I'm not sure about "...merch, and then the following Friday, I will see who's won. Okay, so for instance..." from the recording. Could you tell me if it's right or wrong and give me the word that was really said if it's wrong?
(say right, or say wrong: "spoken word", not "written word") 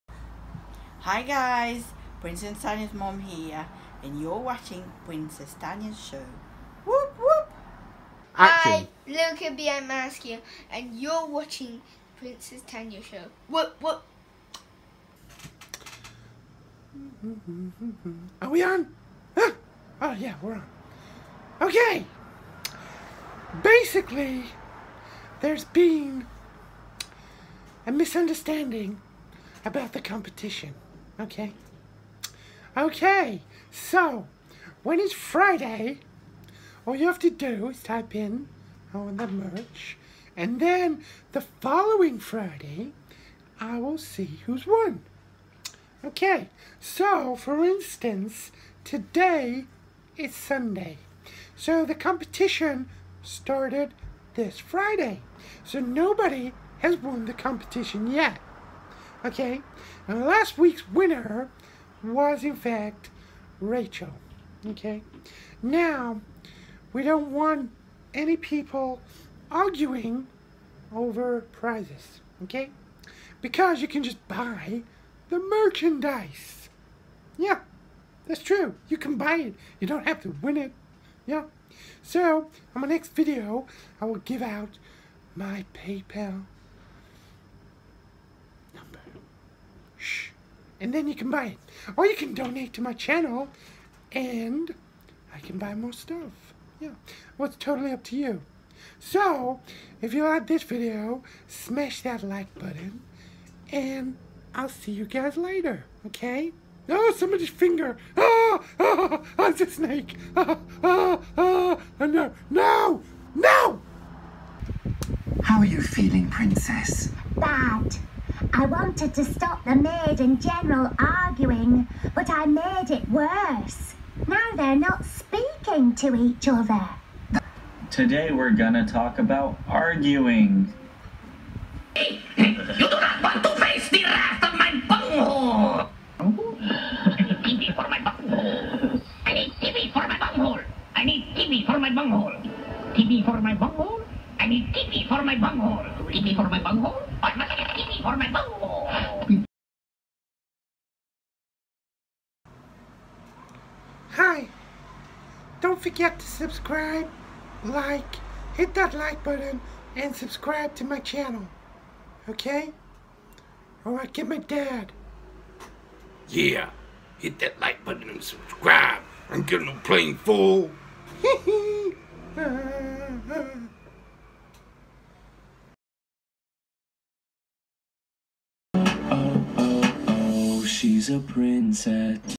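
right.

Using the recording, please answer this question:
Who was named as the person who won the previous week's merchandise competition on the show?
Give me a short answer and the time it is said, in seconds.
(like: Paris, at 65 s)
Rachel, at 63 s.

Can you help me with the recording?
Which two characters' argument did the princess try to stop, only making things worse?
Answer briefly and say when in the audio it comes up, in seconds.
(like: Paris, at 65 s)
the maid and general, at 119 s.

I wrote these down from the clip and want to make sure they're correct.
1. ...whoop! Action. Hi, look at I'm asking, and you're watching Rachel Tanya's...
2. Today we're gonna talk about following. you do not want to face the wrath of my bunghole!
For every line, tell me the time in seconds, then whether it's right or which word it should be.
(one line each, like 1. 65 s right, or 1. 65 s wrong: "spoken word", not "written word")
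1. 7 s wrong: "Princess", not "Rachel"
2. 127 s wrong: "arguing", not "following".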